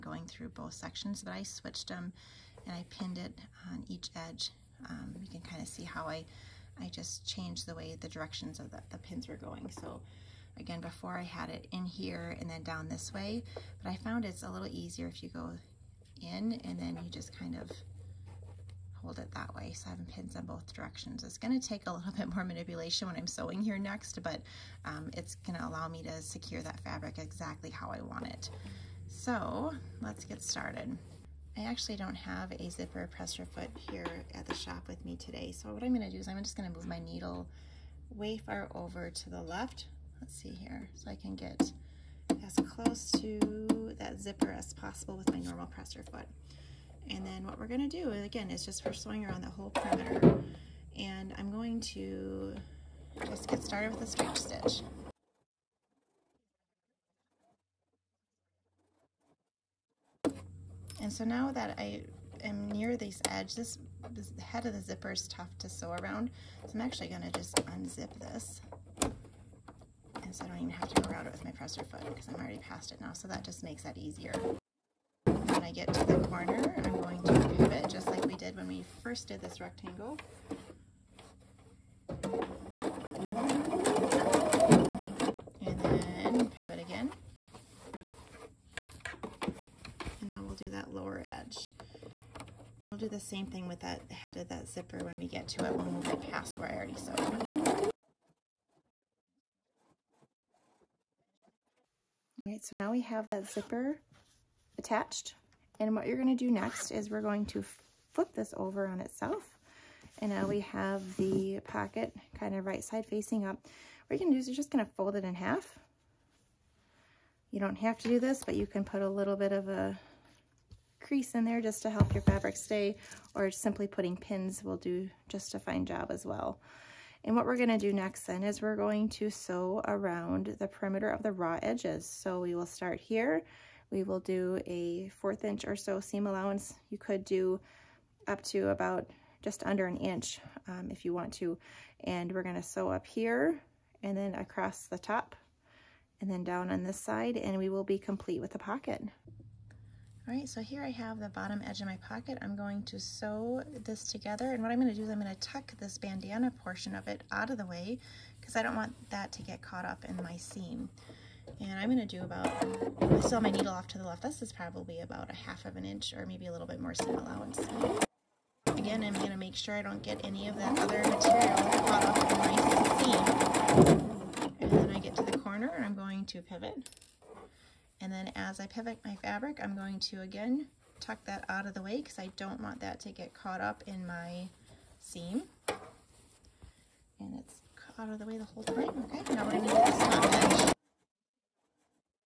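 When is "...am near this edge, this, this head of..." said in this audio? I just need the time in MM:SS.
01:02.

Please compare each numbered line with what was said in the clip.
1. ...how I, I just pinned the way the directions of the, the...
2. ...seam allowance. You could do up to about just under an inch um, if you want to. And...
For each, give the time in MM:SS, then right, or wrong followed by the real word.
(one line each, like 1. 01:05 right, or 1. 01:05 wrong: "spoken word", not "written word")
1. 00:05 wrong: "changed", not "pinned"
2. 02:16 right.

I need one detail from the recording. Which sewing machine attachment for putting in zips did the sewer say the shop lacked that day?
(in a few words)
zipper presser foot.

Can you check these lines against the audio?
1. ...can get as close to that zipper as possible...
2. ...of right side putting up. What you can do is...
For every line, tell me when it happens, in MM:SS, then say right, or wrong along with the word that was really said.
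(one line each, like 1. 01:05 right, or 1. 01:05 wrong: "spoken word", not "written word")
1. 00:41 right
2. 01:52 wrong: "facing", not "putting".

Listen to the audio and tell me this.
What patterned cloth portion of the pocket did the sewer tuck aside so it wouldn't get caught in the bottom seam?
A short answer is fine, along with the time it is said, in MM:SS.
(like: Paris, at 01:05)
bandana, at 02:35.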